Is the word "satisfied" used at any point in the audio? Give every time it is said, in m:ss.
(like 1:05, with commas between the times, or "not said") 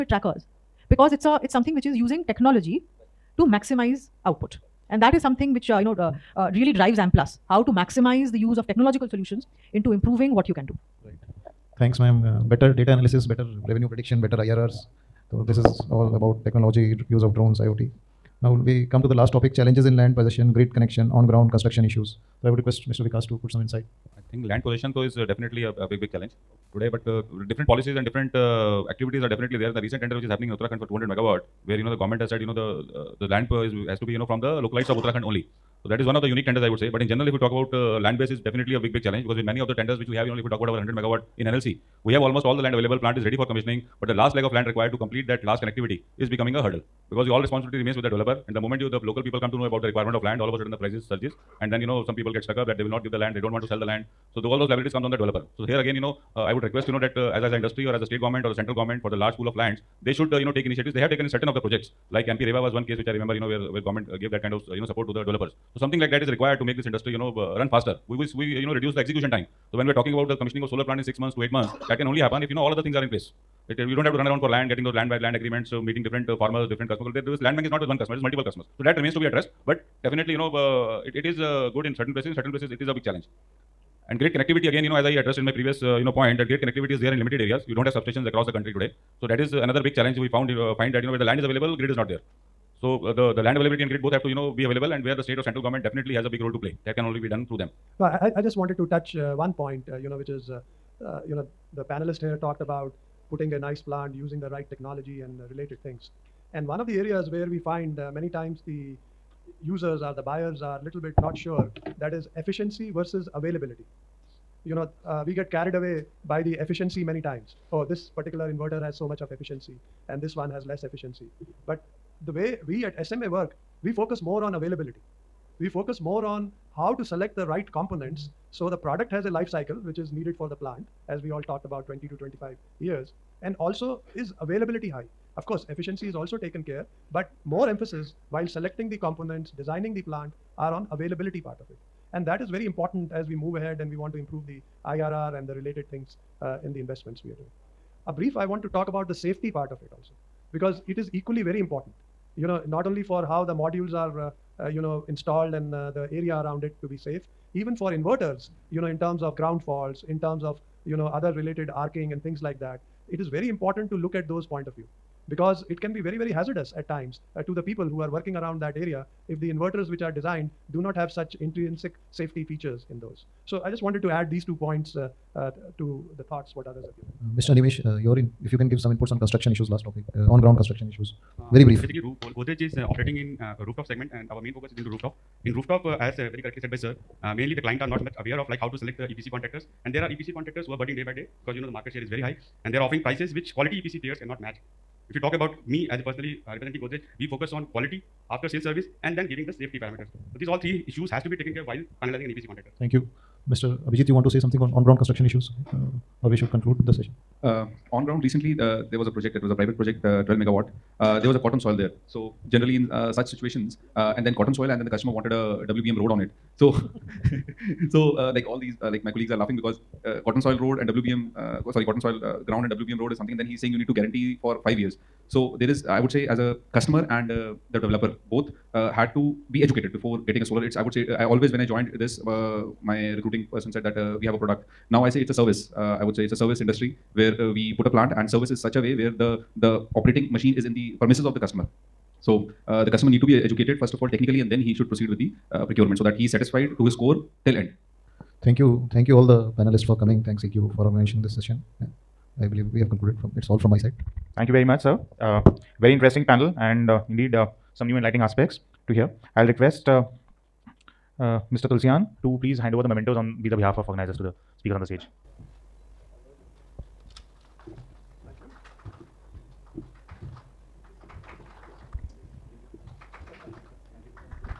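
4:06.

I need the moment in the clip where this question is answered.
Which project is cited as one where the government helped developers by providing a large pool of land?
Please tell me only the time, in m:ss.
1:02.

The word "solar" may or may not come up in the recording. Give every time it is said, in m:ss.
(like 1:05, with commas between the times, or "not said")
1:10, 3:50.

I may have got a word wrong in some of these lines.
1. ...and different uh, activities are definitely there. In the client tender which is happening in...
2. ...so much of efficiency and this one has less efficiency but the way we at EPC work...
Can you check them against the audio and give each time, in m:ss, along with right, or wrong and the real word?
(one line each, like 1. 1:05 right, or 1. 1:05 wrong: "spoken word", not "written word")
1. 0:27 wrong: "recent", not "client"
2. 1:58 wrong: "SMA", not "EPC".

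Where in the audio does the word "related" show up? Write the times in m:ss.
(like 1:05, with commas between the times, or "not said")
1:45, 2:25, 2:41.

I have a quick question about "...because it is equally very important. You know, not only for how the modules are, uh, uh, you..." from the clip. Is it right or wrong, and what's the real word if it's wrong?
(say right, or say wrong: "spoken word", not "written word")
right.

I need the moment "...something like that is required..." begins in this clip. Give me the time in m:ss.
1:05.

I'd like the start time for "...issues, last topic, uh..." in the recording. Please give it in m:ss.
2:59.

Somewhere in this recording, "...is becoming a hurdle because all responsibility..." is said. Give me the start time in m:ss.
0:46.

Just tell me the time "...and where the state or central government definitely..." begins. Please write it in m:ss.
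1:34.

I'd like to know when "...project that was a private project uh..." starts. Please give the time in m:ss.
3:29.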